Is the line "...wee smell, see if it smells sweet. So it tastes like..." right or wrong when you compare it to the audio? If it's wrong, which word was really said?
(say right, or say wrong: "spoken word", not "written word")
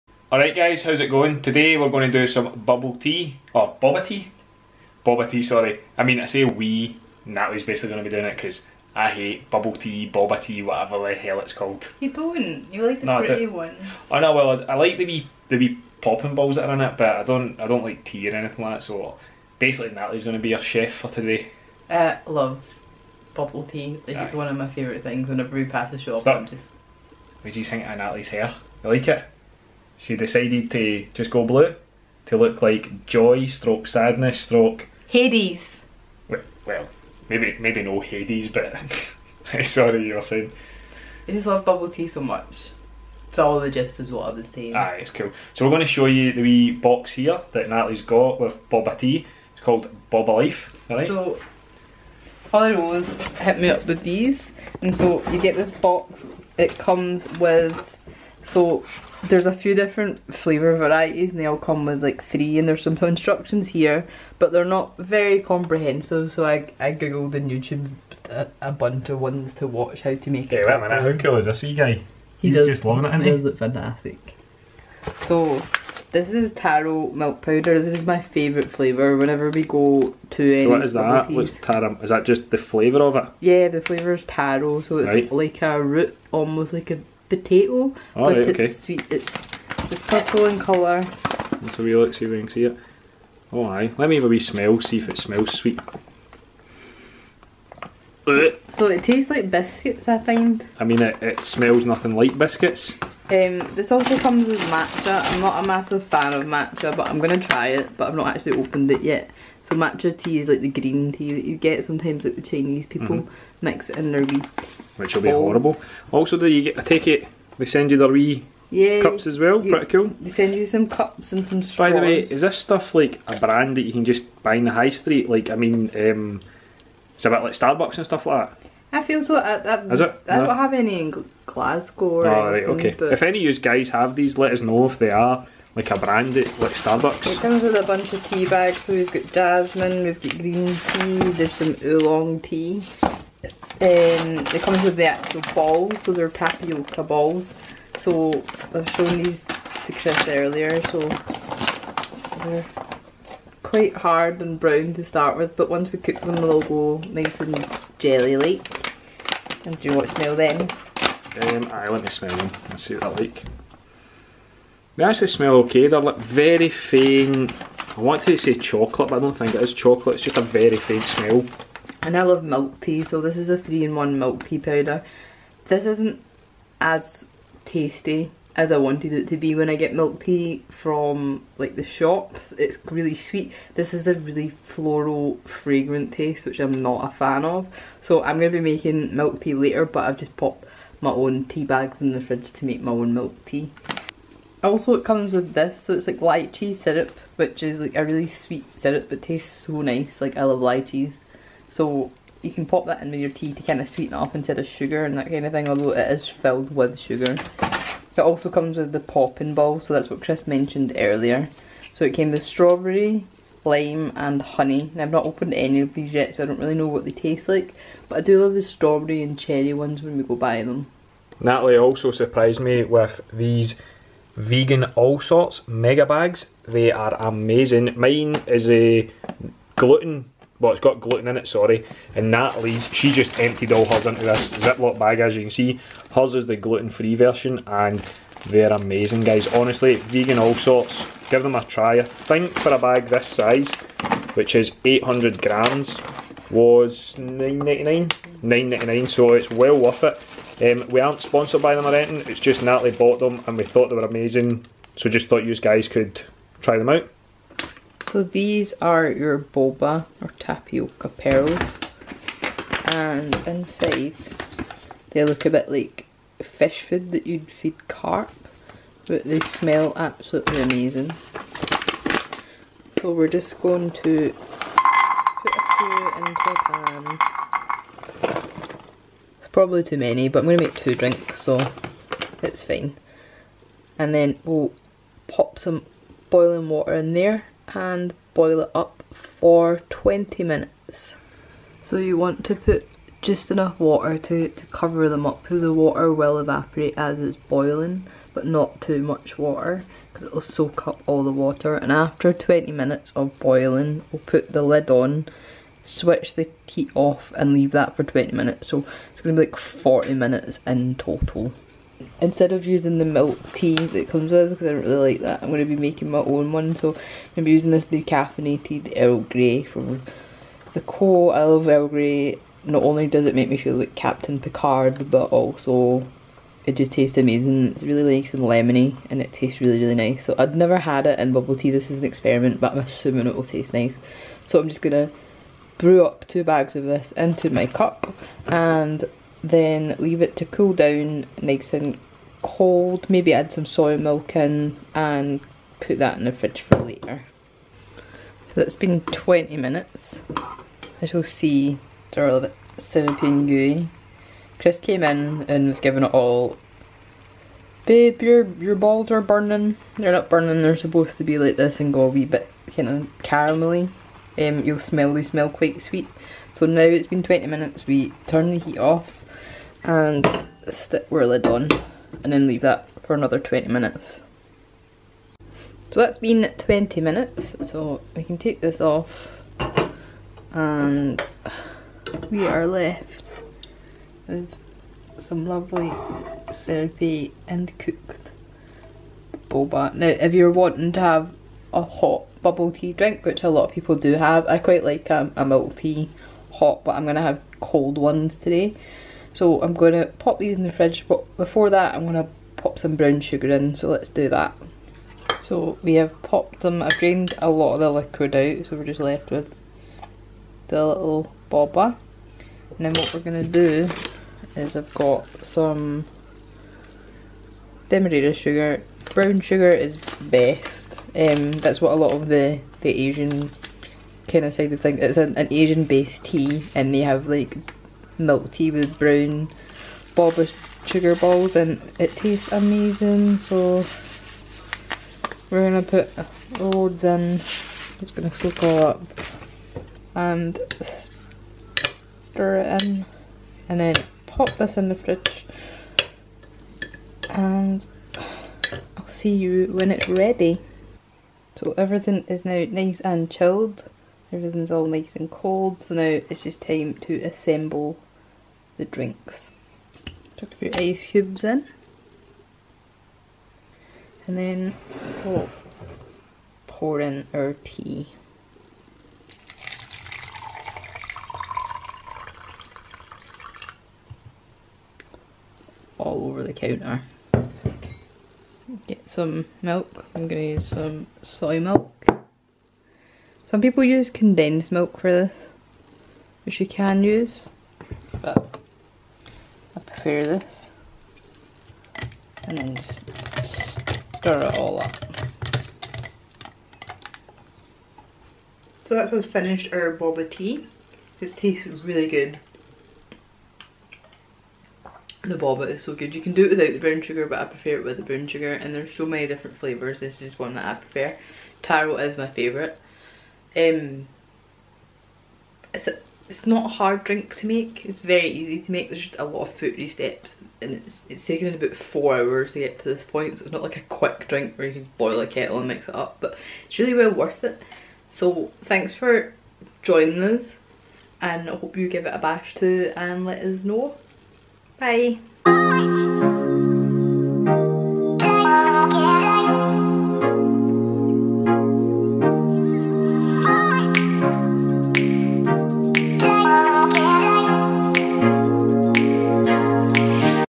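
right.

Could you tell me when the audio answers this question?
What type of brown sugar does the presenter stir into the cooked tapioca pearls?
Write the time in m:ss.
6:57.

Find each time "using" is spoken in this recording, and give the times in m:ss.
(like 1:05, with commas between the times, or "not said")
5:12, 5:17.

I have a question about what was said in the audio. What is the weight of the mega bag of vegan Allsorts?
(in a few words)
800 grams.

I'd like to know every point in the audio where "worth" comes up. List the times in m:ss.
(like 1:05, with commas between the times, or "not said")
4:09, 8:47.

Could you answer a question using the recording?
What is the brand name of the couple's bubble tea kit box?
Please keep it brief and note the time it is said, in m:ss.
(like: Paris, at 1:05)
Boba Life, at 0:50.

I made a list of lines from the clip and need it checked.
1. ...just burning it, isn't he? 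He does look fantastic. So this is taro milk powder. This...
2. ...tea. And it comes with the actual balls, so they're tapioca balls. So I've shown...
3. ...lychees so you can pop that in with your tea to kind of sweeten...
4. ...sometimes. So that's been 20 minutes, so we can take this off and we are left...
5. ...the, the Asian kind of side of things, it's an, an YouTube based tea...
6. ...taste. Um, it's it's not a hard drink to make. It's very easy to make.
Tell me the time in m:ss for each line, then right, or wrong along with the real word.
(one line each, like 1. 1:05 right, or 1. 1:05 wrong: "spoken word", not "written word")
1. 1:12 wrong: "loving", not "burning"
2. 2:22 right
3. 3:20 right
4. 6:13 wrong: "minutes", not "sometimes"
5. 7:02 wrong: "Asian", not "YouTube"
6. 8:32 wrong: "favourite", not "taste".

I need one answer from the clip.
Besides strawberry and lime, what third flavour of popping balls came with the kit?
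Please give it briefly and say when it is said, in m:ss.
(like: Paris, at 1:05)
Honey, at 3:34.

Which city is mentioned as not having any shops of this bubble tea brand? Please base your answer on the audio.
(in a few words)
Glasgow.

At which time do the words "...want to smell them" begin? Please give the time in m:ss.
2:39.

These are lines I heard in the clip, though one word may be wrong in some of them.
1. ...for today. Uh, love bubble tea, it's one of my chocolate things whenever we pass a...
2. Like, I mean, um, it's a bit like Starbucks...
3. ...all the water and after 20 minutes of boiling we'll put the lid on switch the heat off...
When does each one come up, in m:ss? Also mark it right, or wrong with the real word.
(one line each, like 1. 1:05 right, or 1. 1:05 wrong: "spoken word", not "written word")
1. 0:20 wrong: "favourite", not "chocolate"
2. 2:05 right
3. 5:01 right.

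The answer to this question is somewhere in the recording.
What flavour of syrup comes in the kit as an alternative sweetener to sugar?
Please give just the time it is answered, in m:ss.
3:16.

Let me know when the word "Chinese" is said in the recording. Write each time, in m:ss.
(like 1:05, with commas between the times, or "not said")
1:52.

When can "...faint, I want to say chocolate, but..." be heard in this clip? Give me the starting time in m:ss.
2:46.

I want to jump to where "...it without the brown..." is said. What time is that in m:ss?
8:26.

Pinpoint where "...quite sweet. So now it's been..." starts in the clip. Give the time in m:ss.
6:05.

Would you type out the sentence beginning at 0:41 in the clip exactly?
I just love bubble tea so much.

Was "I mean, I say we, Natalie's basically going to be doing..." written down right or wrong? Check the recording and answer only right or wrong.
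right.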